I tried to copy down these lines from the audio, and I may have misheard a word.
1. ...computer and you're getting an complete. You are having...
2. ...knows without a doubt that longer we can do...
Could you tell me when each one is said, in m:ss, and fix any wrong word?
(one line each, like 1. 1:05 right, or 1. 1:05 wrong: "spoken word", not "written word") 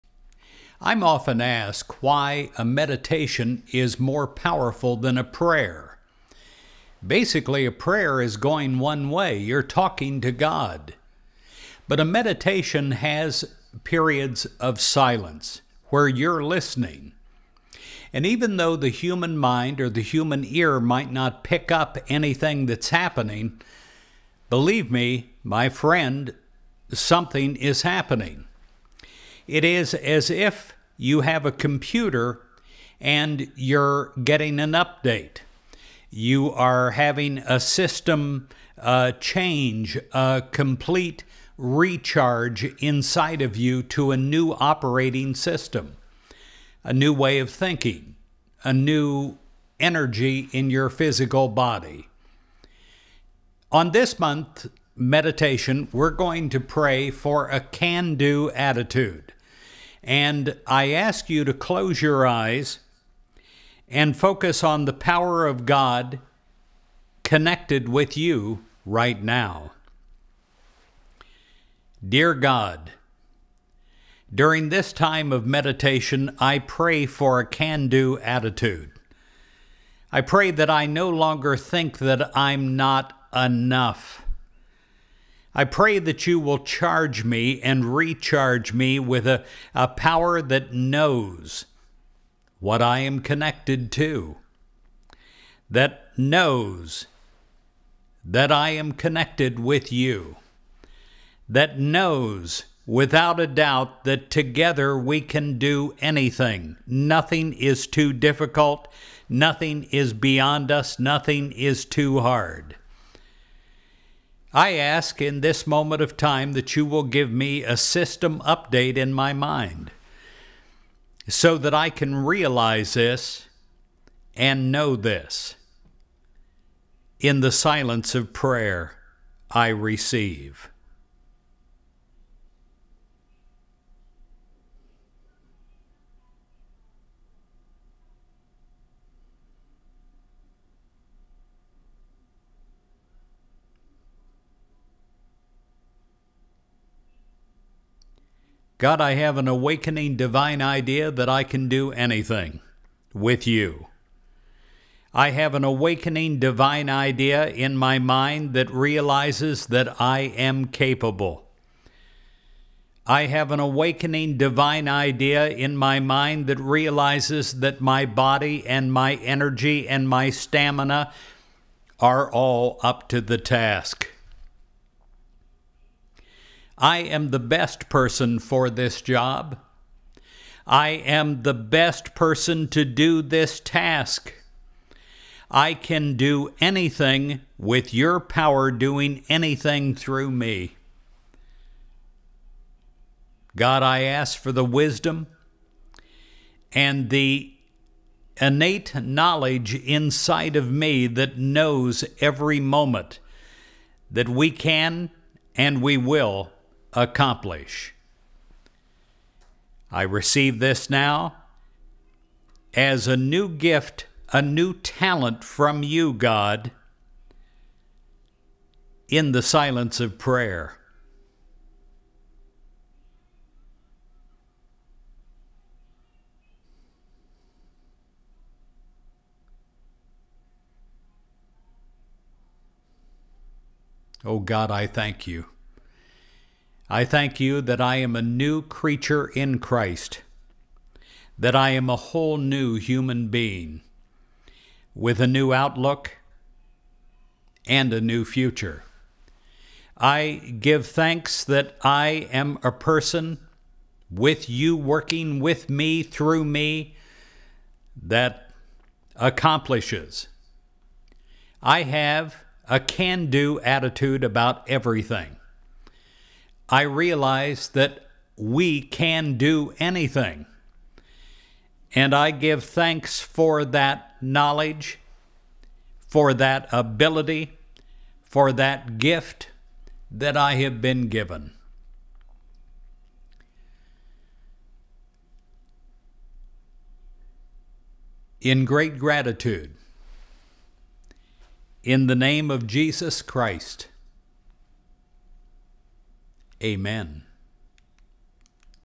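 1. 0:31 wrong: "update", not "complete"
2. 1:41 wrong: "together", not "longer".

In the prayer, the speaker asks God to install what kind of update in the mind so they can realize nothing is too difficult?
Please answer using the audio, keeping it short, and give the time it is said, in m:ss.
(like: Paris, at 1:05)
system update, at 1:57.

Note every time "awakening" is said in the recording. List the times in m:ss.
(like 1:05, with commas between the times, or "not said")
2:29, 2:35, 2:43.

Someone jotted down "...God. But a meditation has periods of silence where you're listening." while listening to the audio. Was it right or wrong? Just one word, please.
right.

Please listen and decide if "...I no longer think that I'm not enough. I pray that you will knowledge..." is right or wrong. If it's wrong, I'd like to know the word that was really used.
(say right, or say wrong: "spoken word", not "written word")
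wrong: "charge", not "knowledge".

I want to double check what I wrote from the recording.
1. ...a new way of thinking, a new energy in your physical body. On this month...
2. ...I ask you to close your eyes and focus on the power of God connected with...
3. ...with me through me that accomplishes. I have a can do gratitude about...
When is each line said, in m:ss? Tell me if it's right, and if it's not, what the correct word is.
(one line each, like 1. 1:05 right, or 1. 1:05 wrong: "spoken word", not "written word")
1. 0:46 right
2. 1:00 right
3. 4:15 wrong: "attitude", not "gratitude".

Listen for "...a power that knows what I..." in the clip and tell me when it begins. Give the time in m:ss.
1:29.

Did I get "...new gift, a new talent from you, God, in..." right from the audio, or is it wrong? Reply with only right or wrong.
right.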